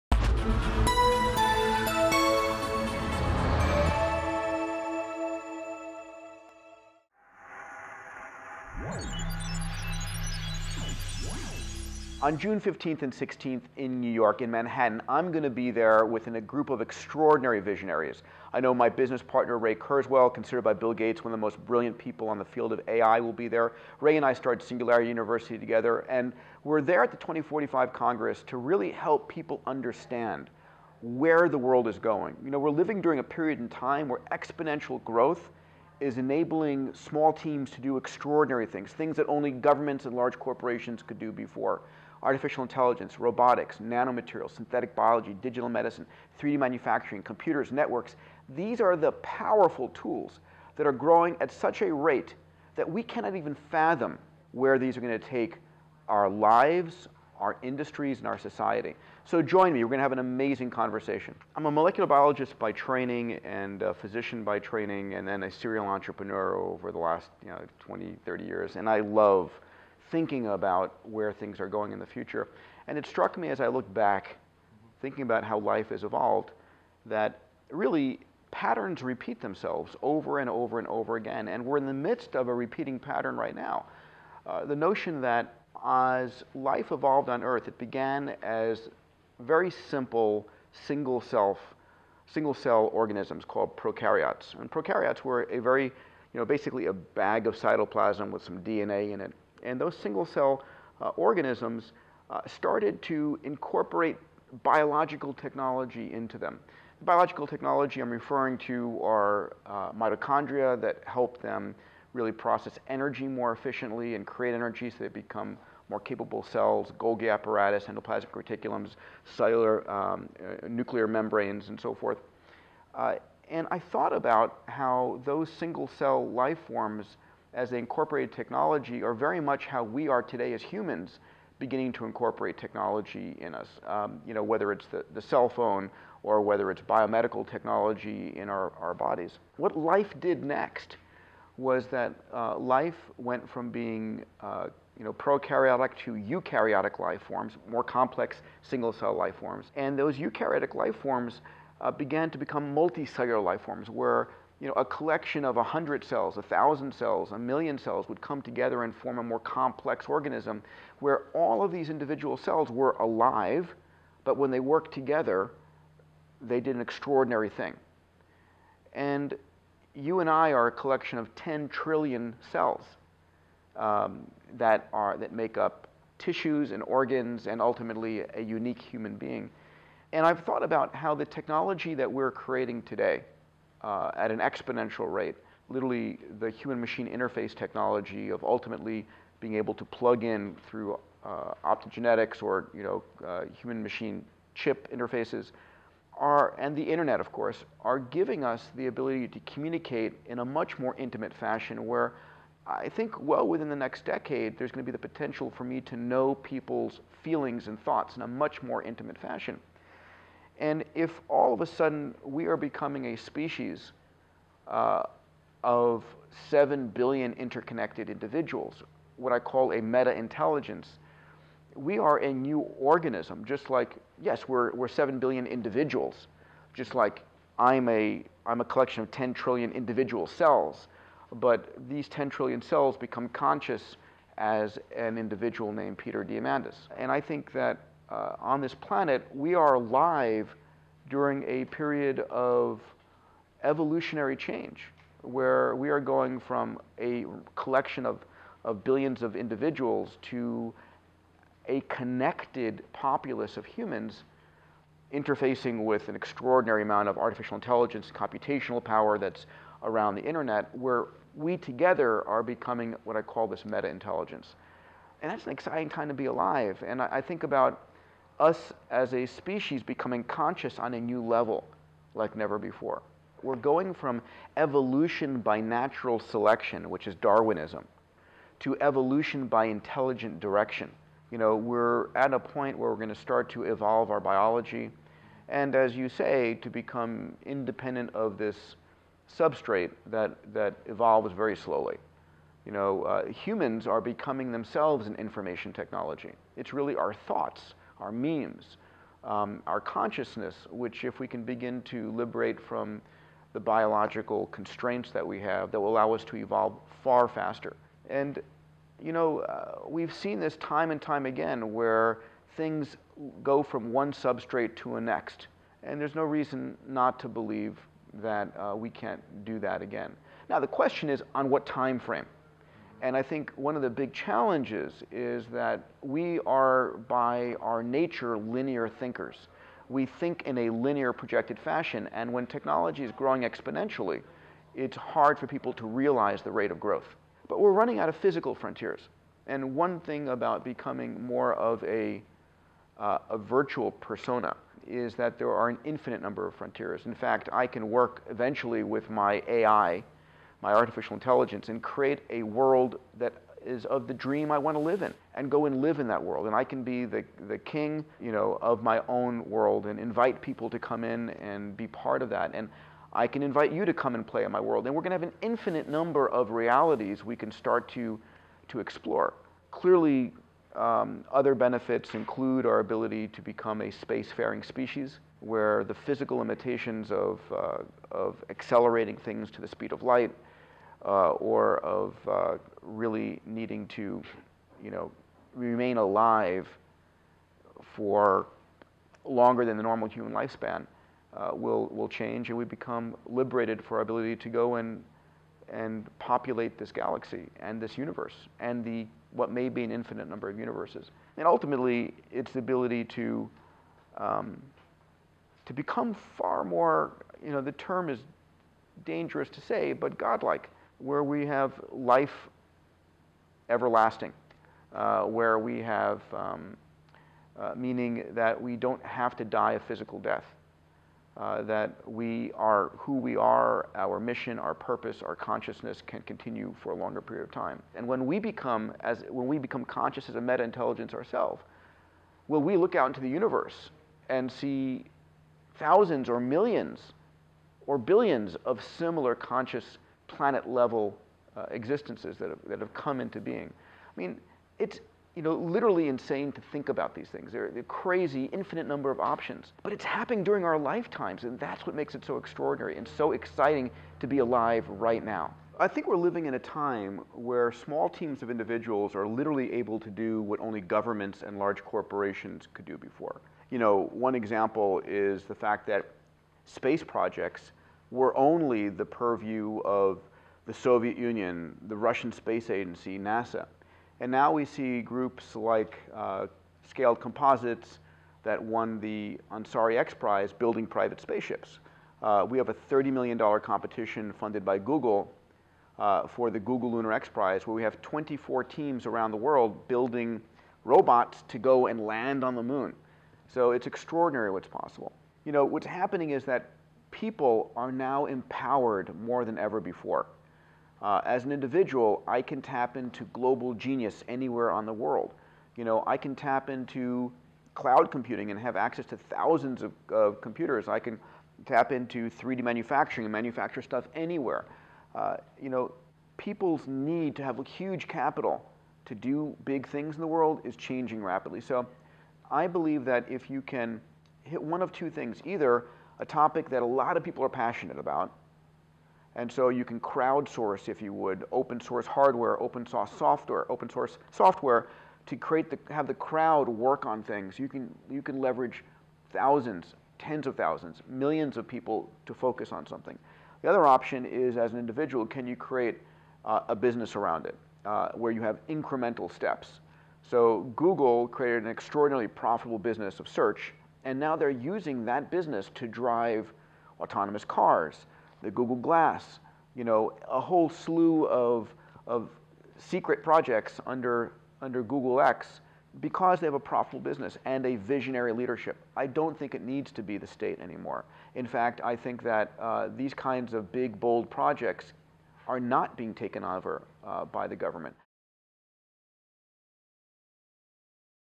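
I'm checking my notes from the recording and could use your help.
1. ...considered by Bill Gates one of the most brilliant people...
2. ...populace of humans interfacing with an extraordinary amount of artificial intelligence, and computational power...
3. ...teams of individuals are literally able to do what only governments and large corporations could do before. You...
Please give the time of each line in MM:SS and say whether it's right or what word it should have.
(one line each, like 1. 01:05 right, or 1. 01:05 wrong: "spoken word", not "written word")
1. 00:20 right
2. 04:12 right
3. 07:38 right.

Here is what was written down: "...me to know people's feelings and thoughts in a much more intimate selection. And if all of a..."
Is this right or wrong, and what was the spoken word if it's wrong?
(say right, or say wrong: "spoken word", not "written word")
wrong: "fashion", not "selection".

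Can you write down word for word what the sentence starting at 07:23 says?
I mean, it's you know, literally insane to think about these things.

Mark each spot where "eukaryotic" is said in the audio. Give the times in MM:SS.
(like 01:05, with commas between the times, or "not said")
02:26, 02:30.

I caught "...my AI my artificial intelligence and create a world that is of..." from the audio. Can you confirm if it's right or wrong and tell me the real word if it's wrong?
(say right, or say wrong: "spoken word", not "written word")
right.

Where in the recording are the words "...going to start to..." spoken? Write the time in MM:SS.
04:42.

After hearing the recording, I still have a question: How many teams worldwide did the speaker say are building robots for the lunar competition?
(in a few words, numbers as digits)
24.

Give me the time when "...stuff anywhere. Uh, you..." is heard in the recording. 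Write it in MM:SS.
08:33.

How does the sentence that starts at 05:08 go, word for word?
And, you know, uh, we've seen this time and time again where things go from one substrate to a next.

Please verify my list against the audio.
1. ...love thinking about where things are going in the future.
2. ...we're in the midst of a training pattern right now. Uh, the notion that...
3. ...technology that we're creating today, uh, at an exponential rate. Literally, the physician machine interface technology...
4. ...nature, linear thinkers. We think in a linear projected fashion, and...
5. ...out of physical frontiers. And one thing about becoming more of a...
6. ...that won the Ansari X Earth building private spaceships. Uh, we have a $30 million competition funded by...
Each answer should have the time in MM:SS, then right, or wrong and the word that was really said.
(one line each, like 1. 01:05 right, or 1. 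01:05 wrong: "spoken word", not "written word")
1. 01:08 right
2. 01:21 wrong: "repeating", not "training"
3. 03:01 wrong: "human", not "physician"
4. 05:27 right
5. 05:37 right
6. 07:58 wrong: "Prize", not "Earth".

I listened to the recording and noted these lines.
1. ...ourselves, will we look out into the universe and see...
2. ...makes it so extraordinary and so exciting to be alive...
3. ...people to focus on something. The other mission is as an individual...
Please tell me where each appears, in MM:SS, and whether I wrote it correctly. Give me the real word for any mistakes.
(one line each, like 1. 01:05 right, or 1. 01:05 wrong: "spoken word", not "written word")
1. 07:11 right
2. 07:31 right
3. 09:01 wrong: "option", not "mission".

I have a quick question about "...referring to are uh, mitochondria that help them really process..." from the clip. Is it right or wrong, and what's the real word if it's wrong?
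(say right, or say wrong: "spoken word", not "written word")
right.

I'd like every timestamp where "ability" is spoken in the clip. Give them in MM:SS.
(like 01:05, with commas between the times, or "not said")
03:18, 06:12, 06:34, 06:42.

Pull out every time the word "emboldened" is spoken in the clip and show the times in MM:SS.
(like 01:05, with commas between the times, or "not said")
not said.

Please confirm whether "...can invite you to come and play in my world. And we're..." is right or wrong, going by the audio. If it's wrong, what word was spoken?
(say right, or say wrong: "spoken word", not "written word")
right.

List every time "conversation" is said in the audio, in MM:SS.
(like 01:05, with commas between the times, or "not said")
01:00.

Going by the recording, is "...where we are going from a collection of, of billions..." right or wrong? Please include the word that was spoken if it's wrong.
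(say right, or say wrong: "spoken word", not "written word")
right.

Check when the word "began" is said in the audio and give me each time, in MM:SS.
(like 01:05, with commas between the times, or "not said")
01:27, 02:31.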